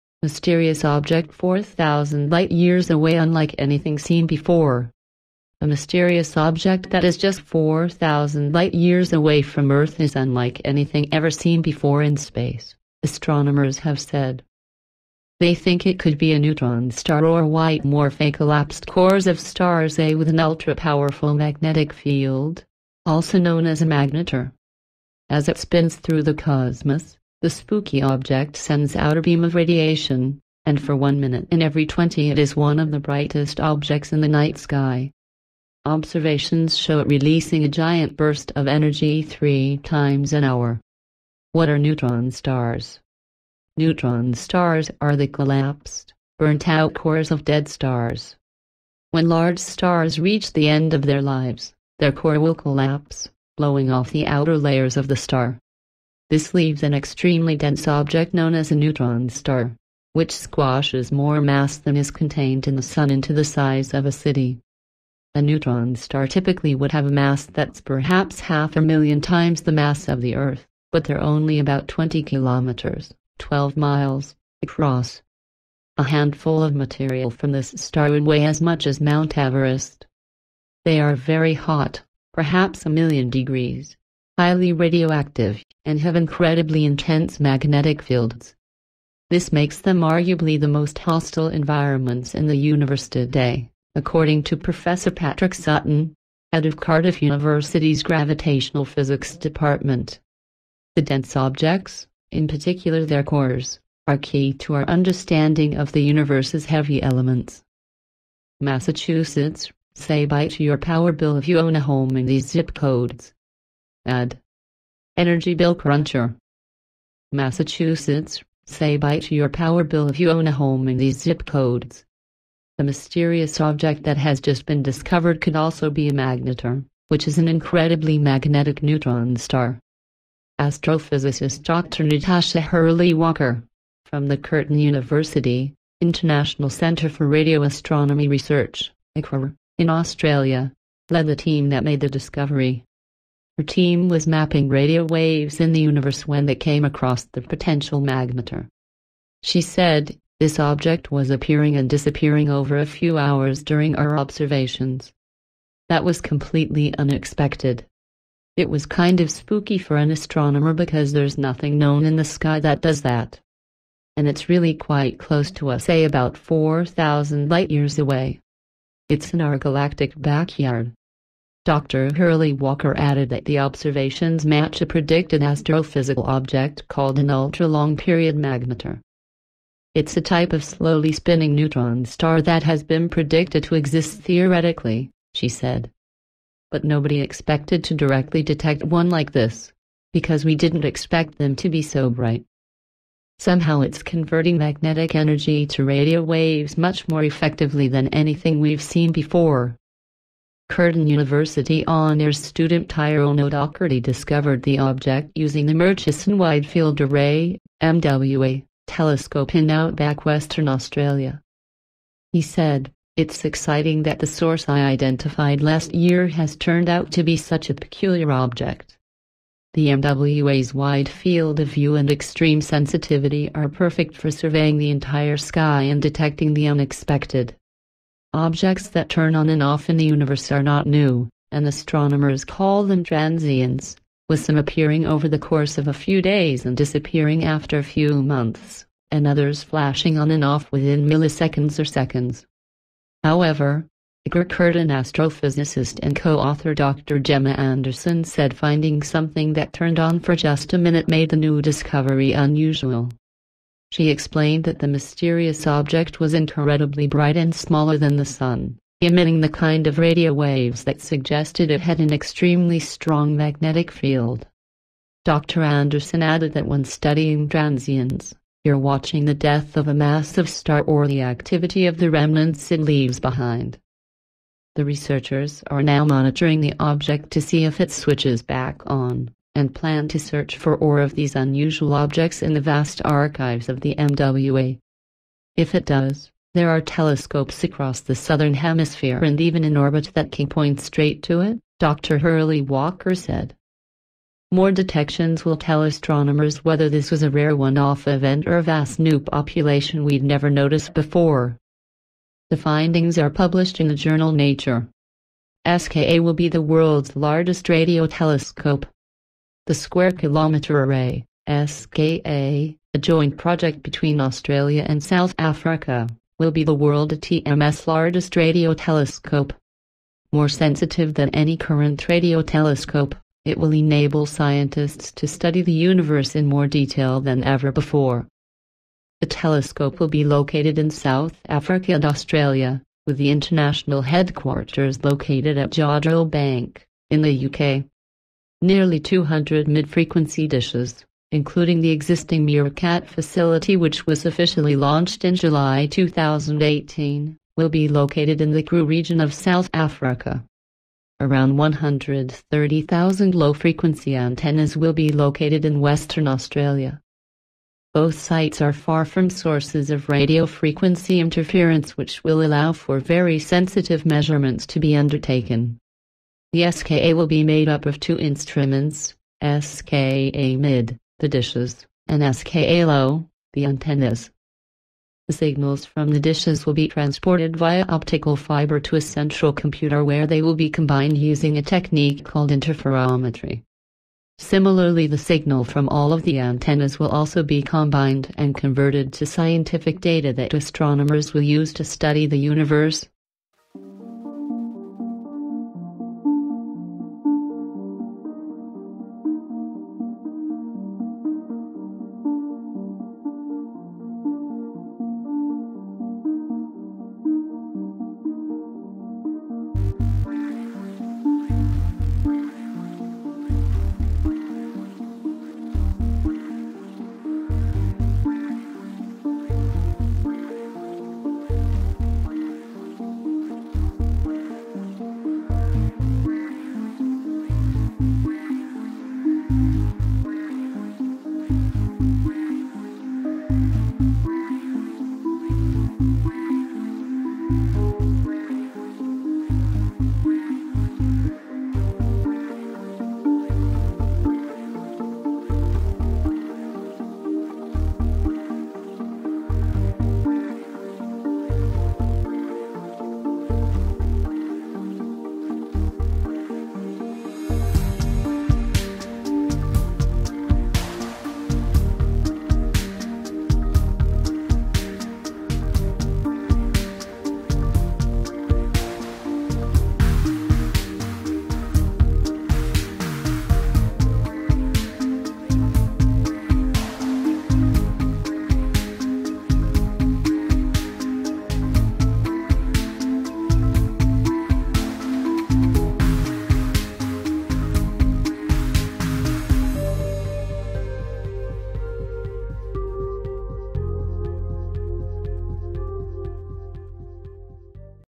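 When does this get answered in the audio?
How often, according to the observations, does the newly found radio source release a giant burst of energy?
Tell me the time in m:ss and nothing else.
0:39.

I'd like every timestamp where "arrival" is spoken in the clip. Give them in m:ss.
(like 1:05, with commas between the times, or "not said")
not said.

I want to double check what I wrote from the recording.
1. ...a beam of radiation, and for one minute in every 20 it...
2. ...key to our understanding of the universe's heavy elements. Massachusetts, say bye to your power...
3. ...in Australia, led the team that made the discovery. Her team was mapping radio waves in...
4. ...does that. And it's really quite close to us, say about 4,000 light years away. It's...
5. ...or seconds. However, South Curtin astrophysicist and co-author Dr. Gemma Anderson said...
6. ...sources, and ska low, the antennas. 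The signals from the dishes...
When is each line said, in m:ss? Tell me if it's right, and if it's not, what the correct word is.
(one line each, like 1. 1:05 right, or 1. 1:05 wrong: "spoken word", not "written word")
1. 0:29 right
2. 1:44 right
3. 2:19 right
4. 2:42 right
5. 4:01 wrong: "Igor", not "South"
6. 6:11 wrong: "dishes", not "sources".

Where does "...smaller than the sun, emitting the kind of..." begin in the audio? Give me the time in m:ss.
4:17.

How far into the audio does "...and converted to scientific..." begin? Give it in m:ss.
6:28.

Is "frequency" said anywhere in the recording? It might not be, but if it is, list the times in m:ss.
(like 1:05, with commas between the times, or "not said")
5:39, 5:53, 6:00.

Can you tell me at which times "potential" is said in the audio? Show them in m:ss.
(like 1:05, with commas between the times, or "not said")
2:27.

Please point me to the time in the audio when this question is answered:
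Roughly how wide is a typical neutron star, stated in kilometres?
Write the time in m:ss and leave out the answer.
1:11.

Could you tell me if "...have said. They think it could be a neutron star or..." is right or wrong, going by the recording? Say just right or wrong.
right.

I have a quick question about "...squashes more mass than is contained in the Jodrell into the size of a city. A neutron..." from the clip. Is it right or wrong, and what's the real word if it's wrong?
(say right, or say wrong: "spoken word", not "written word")
wrong: "Sun", not "Jodrell".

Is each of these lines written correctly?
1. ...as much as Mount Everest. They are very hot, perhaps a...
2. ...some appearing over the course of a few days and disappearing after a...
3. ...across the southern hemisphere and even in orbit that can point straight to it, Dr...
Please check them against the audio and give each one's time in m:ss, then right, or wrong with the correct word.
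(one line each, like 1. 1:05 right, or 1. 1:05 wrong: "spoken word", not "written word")
1. 1:18 right
2. 3:54 right
3. 4:47 right.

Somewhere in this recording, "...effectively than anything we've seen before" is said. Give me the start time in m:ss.
3:17.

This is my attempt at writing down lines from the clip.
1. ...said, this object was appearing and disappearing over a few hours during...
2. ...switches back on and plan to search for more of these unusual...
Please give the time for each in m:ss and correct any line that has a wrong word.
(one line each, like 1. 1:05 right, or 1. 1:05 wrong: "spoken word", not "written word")
1. 2:29 right
2. 4:37 right.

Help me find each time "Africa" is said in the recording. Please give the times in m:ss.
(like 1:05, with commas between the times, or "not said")
5:15, 5:31, 5:49.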